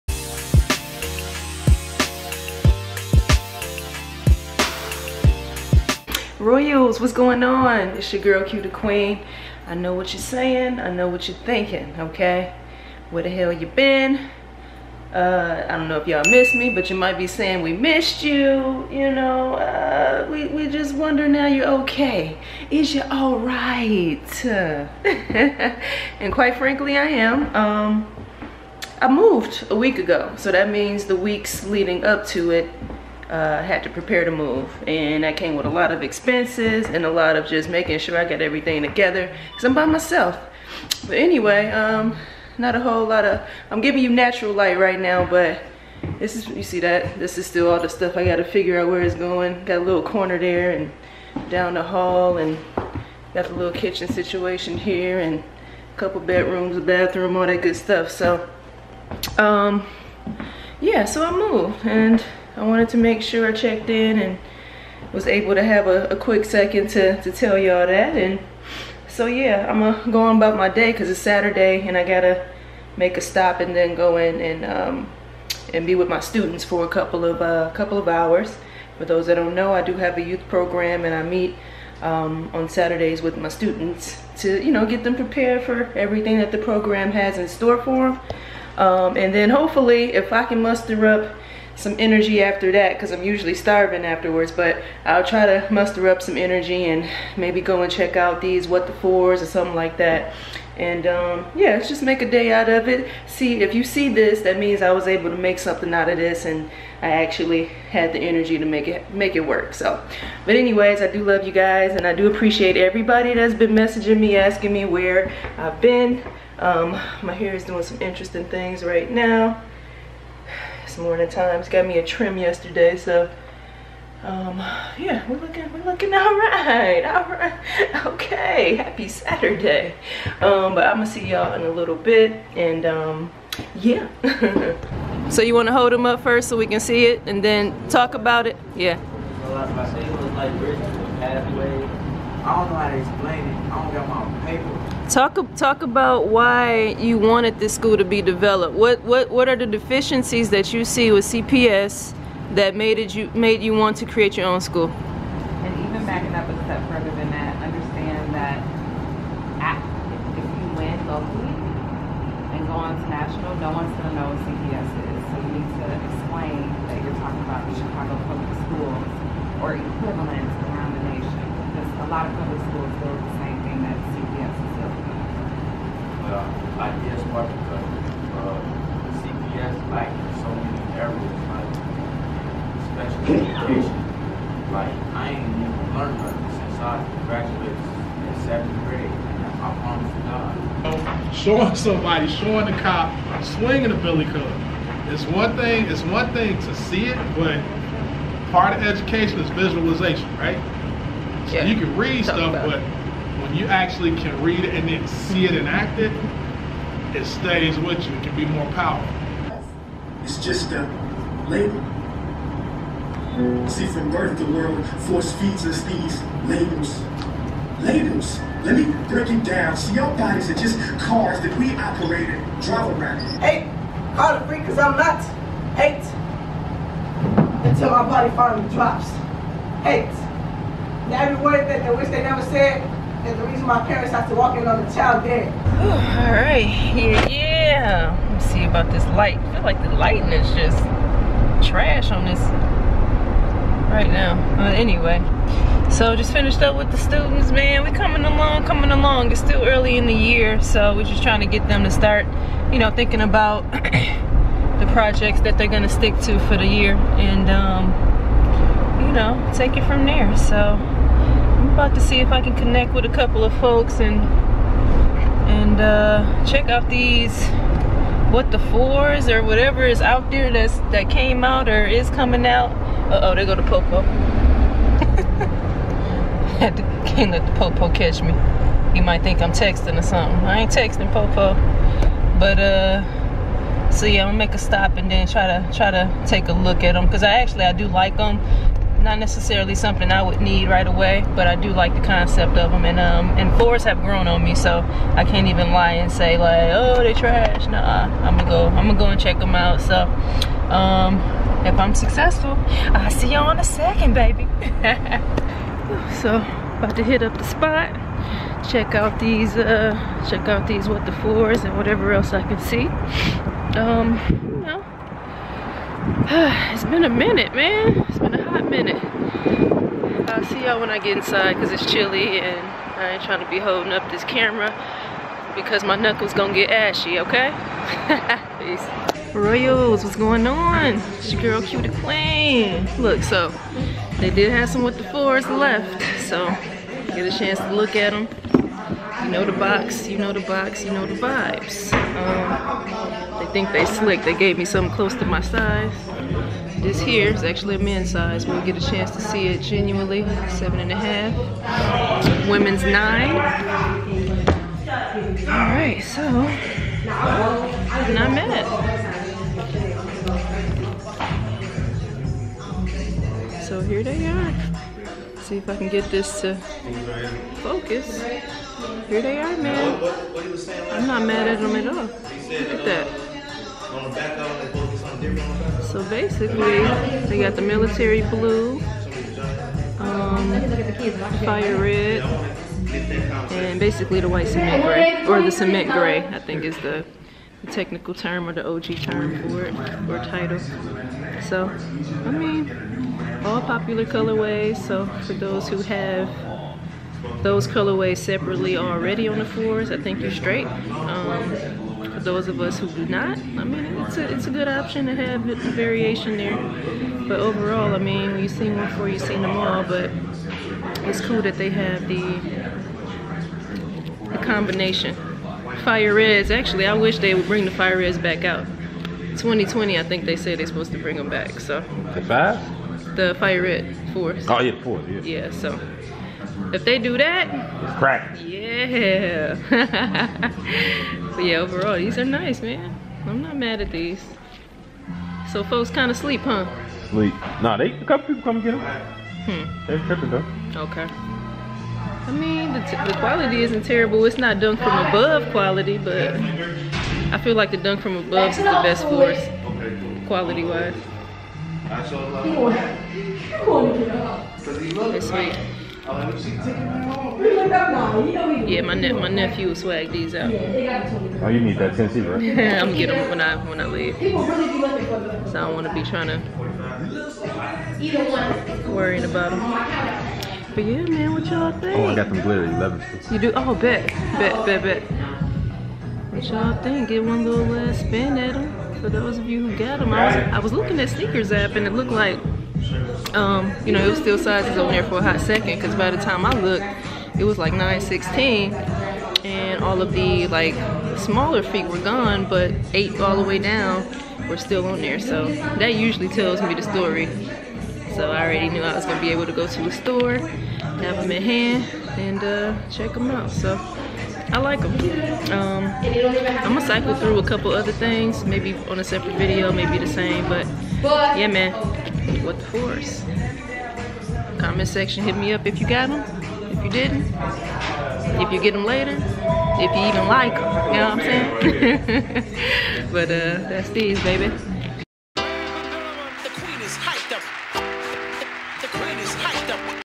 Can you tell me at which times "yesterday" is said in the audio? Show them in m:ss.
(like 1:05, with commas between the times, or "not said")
2:02.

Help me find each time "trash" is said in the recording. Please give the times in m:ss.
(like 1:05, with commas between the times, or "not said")
4:01, 4:57.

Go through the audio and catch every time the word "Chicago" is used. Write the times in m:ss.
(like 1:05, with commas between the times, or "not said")
2:47.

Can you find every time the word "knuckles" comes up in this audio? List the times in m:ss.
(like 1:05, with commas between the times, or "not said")
5:25.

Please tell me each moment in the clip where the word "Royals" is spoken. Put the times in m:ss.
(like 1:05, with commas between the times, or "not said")
0:06, 5:29.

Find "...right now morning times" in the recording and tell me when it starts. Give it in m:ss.
1:58.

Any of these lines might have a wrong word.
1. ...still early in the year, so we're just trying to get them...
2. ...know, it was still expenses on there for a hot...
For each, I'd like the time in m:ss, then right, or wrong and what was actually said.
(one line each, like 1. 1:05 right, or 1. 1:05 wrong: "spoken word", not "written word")
1. 4:09 right
2. 8:03 wrong: "sizes", not "expenses".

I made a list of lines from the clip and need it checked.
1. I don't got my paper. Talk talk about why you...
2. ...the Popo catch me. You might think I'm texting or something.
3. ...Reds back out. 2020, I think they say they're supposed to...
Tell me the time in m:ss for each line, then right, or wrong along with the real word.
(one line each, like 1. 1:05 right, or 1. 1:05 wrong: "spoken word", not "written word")
1. 2:23 right
2. 4:37 right
3. 6:57 right.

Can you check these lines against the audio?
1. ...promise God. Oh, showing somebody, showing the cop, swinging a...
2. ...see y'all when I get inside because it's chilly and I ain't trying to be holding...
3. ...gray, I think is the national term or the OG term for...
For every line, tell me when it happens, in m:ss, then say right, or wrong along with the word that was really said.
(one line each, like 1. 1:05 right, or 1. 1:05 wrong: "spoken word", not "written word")
1. 3:09 right
2. 5:20 right
3. 6:25 wrong: "technical", not "national".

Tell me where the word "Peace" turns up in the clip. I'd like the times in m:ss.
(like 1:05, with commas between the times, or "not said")
5:28.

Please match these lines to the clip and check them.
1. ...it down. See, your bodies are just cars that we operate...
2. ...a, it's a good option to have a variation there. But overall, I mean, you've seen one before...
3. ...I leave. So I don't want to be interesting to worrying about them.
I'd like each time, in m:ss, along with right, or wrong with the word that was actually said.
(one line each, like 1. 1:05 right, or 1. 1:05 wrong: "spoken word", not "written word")
1. 3:39 right
2. 6:44 right
3. 7:43 wrong: "trying", not "interesting".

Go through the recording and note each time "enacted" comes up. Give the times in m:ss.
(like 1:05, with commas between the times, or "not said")
3:25.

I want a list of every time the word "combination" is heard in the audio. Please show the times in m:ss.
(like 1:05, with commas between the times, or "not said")
6:54.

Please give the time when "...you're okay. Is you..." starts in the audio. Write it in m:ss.
0:21.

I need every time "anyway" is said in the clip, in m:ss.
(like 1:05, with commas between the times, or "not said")
0:41, 1:50, 4:04.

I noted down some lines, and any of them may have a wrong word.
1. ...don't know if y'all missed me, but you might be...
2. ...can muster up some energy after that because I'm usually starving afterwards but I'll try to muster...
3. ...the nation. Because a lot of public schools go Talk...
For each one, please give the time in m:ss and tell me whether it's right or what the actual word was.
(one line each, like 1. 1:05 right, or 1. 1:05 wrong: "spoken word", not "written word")
1. 0:15 right
2. 1:30 right
3. 2:50 wrong: "IES", not "Talk".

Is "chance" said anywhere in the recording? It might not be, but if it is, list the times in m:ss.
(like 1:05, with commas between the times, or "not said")
5:37, 5:48.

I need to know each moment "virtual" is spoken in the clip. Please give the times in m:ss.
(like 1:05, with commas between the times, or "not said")
not said.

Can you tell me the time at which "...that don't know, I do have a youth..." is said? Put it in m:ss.
1:19.